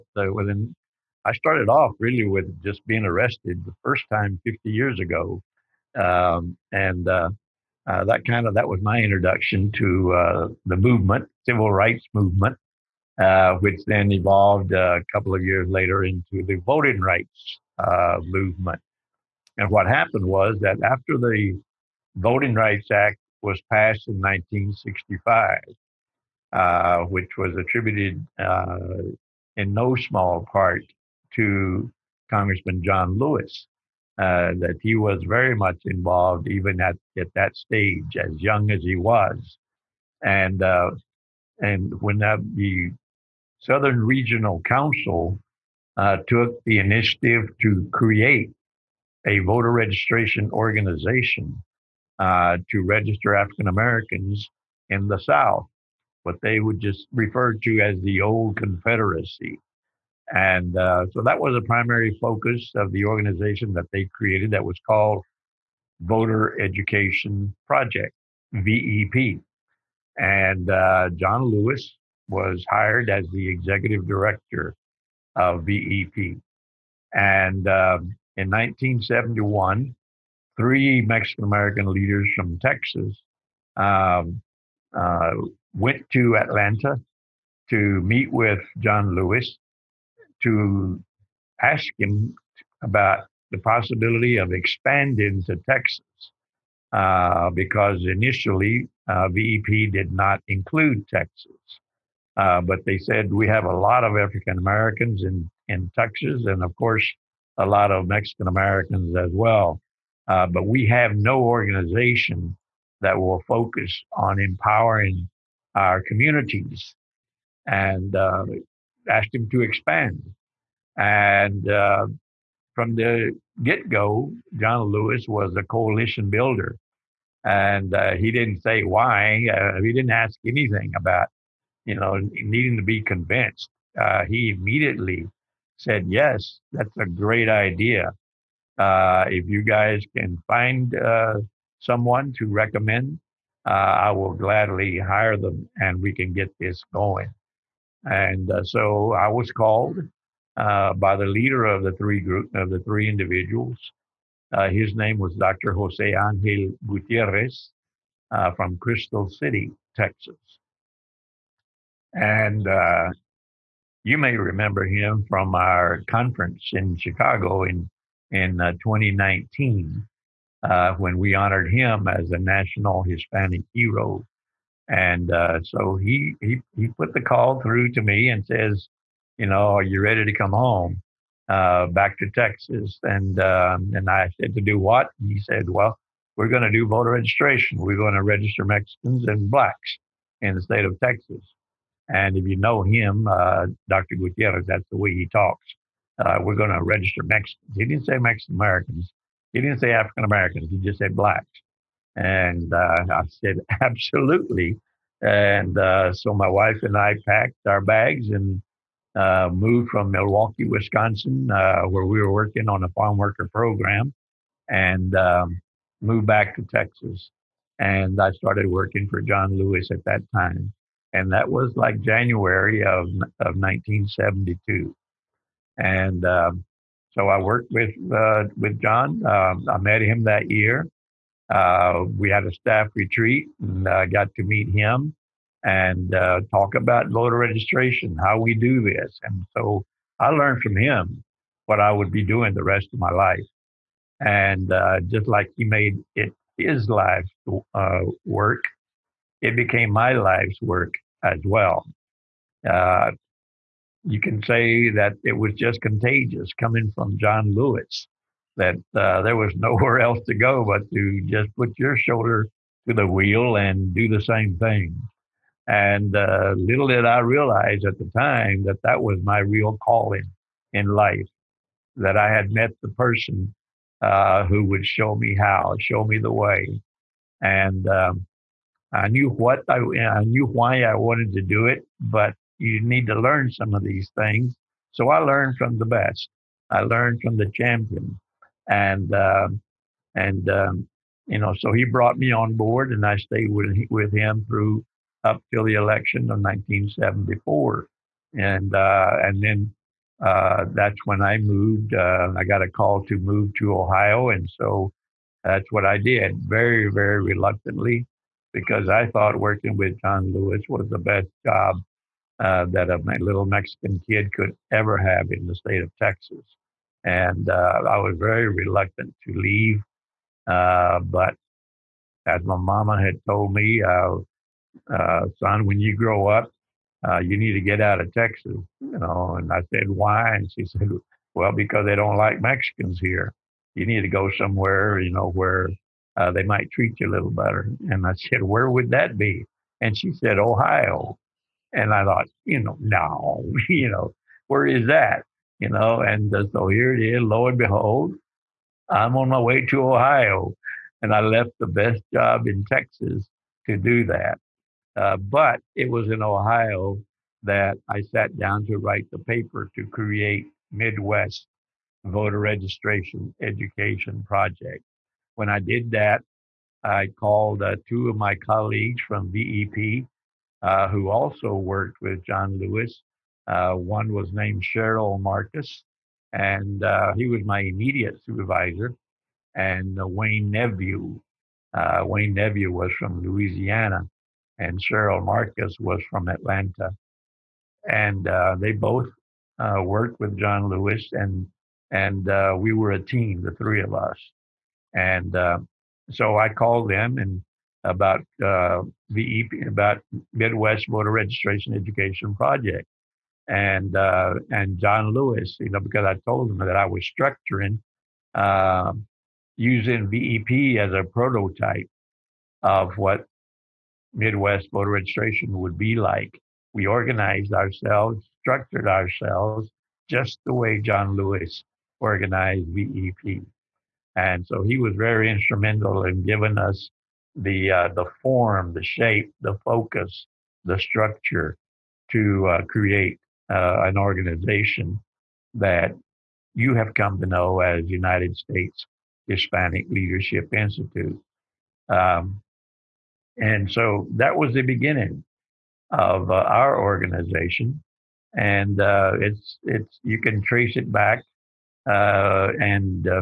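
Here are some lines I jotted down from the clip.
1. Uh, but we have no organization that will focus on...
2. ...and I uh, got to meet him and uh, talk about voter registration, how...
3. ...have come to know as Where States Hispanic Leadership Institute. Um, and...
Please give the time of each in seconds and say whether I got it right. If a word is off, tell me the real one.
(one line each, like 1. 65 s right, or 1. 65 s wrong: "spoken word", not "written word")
1. 110 s right
2. 233 s right
3. 436 s wrong: "United", not "Where".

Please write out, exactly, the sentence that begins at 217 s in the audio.
And I started working for John Lewis at that time and that was like January of of 1972.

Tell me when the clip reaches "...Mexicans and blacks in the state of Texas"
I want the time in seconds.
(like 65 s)
188 s.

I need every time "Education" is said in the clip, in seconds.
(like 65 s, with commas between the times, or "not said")
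66 s, 363 s, 401 s.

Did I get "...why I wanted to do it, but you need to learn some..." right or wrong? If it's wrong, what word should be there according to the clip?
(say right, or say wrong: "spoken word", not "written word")
right.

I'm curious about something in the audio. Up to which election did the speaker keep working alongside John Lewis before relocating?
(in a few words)
1974.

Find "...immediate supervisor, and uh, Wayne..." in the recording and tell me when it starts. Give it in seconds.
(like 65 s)
377 s.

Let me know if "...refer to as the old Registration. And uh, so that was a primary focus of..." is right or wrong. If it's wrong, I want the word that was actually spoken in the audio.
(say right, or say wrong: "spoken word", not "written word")
wrong: "Confederacy", not "Registration".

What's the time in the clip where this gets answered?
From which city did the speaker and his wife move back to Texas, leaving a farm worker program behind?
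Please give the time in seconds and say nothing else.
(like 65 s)
210 s.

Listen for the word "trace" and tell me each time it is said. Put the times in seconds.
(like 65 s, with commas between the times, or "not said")
450 s.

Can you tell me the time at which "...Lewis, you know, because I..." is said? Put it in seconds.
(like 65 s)
405 s.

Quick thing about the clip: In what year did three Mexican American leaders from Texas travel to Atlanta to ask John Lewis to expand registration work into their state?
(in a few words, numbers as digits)
1971.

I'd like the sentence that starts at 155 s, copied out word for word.
Jose Angel Gutierrez from Crystal City, Texas.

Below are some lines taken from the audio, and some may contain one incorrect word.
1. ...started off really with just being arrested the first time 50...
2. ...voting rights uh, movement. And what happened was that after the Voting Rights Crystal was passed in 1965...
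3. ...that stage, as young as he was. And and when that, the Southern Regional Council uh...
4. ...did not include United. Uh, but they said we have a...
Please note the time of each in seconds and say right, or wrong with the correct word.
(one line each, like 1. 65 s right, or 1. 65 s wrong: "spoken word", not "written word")
1. 1 s right
2. 16 s wrong: "Act", not "Crystal"
3. 37 s right
4. 99 s wrong: "Texas", not "United".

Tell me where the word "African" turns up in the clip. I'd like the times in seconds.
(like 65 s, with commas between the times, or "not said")
53 s, 104 s, 199 s.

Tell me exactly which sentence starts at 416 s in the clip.
We organized ourselves, structured ourselves, just the way John Lewis organized VEP.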